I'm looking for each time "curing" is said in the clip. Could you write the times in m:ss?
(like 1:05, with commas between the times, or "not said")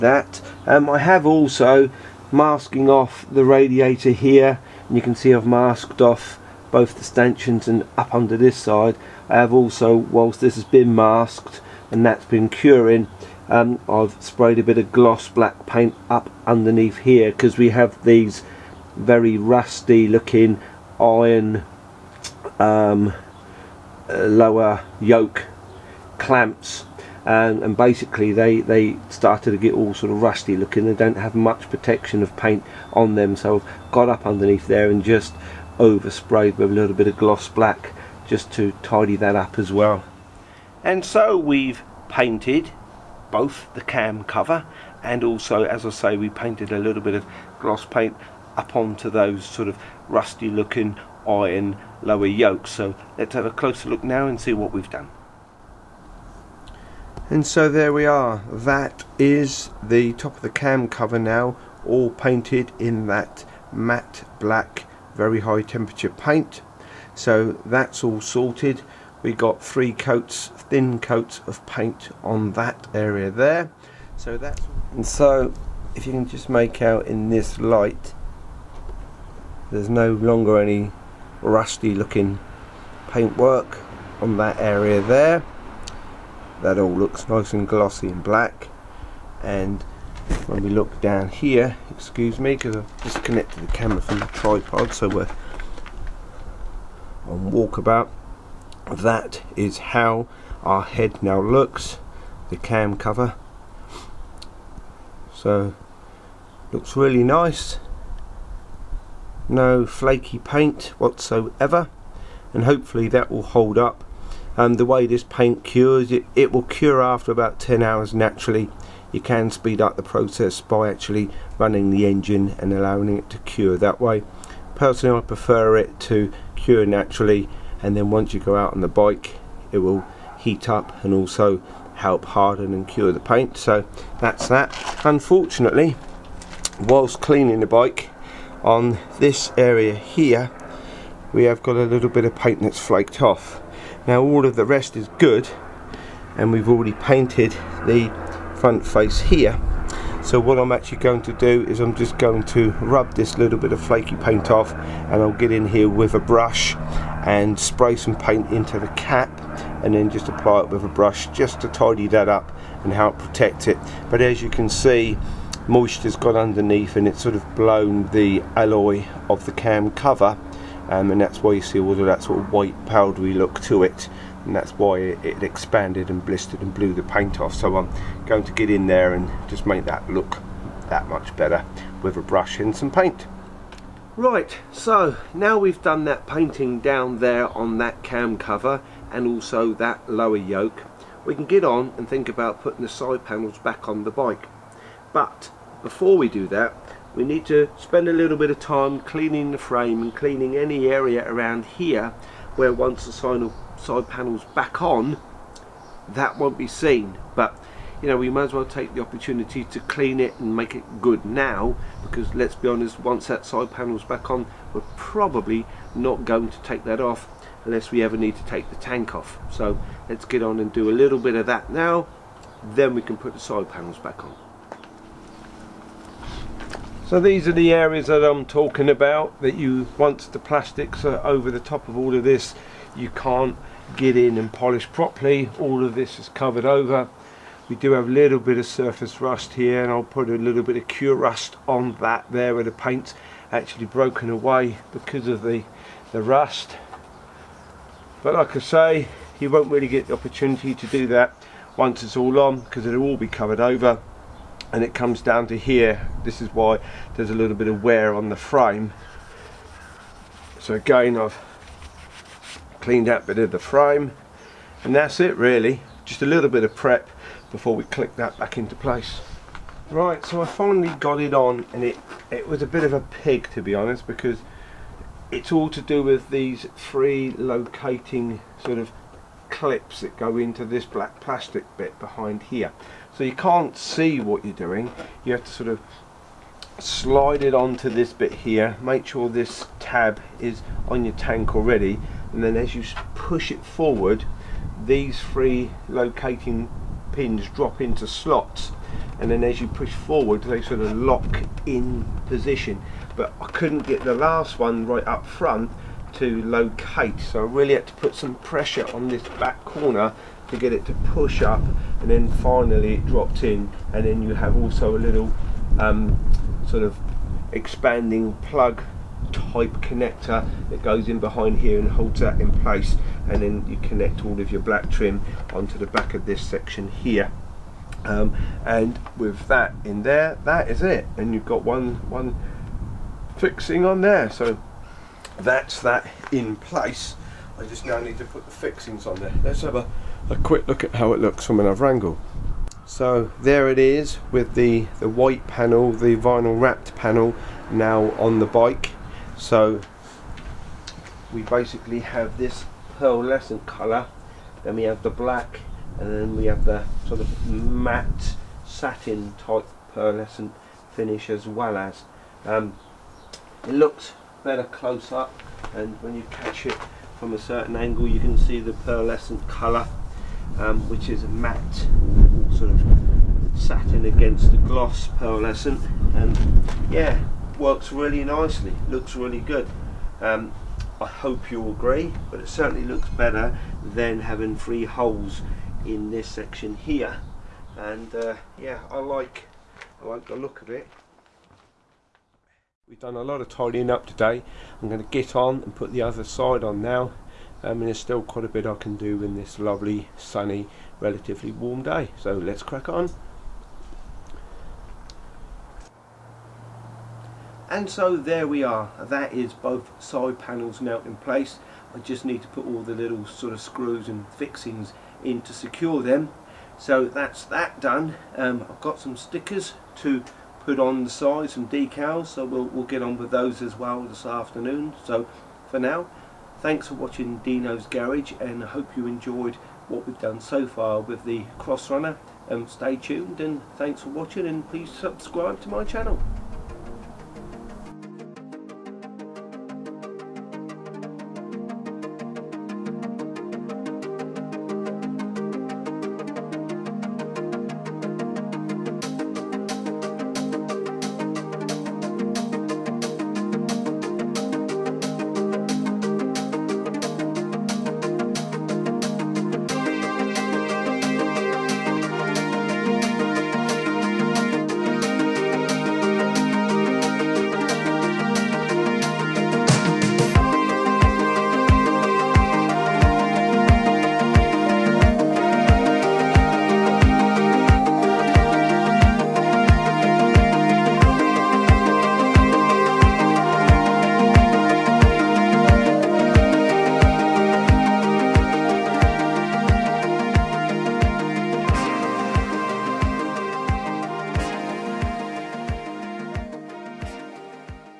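0:12.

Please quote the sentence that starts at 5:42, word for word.
So there it is with the, the white panel, the vinyl wrapped panel now on the bike.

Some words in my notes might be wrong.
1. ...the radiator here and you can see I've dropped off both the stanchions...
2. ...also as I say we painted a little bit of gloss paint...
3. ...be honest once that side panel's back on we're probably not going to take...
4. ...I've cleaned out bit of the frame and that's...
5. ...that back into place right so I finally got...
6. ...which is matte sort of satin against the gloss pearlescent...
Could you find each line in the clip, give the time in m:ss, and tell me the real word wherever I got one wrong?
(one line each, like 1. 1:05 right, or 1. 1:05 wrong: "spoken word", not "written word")
1. 0:03 wrong: "masked", not "dropped"
2. 0:45 right
3. 3:32 right
4. 4:21 right
5. 4:28 right
6. 6:10 right.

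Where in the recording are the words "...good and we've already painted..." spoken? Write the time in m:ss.
2:25.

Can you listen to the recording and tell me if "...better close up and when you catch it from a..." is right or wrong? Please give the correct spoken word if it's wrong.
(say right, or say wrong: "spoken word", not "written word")
right.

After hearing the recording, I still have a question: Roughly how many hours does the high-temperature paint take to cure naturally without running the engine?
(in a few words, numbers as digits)
10.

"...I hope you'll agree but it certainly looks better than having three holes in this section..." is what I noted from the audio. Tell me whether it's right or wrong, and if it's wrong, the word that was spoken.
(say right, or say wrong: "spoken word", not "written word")
right.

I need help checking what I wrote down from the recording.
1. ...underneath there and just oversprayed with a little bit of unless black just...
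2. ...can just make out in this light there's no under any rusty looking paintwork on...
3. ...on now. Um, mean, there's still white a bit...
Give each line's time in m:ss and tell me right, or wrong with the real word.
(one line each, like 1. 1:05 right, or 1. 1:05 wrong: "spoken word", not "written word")
1. 0:34 wrong: "gloss", not "unless"
2. 1:16 wrong: "longer", not "under"
3. 6:36 wrong: "quite", not "white".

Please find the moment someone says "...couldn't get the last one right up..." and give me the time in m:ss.
5:03.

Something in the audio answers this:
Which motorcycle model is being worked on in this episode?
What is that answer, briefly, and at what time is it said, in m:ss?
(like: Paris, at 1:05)
Crossrunner, at 7:11.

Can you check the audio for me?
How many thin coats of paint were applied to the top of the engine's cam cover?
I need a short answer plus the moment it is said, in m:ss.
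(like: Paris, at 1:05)
3, at 1:09.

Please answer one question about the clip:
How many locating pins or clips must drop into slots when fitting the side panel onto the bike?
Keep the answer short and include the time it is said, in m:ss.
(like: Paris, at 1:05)
3, at 4:55.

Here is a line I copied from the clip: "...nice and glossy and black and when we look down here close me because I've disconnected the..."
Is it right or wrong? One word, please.
wrong.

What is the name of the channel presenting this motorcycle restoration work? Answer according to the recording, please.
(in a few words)
Deano's Garage.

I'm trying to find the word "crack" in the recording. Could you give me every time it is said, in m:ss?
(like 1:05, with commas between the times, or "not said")
6:42.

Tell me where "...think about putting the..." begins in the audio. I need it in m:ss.
3:12.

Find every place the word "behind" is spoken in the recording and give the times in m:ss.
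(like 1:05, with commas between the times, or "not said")
4:41, 5:21.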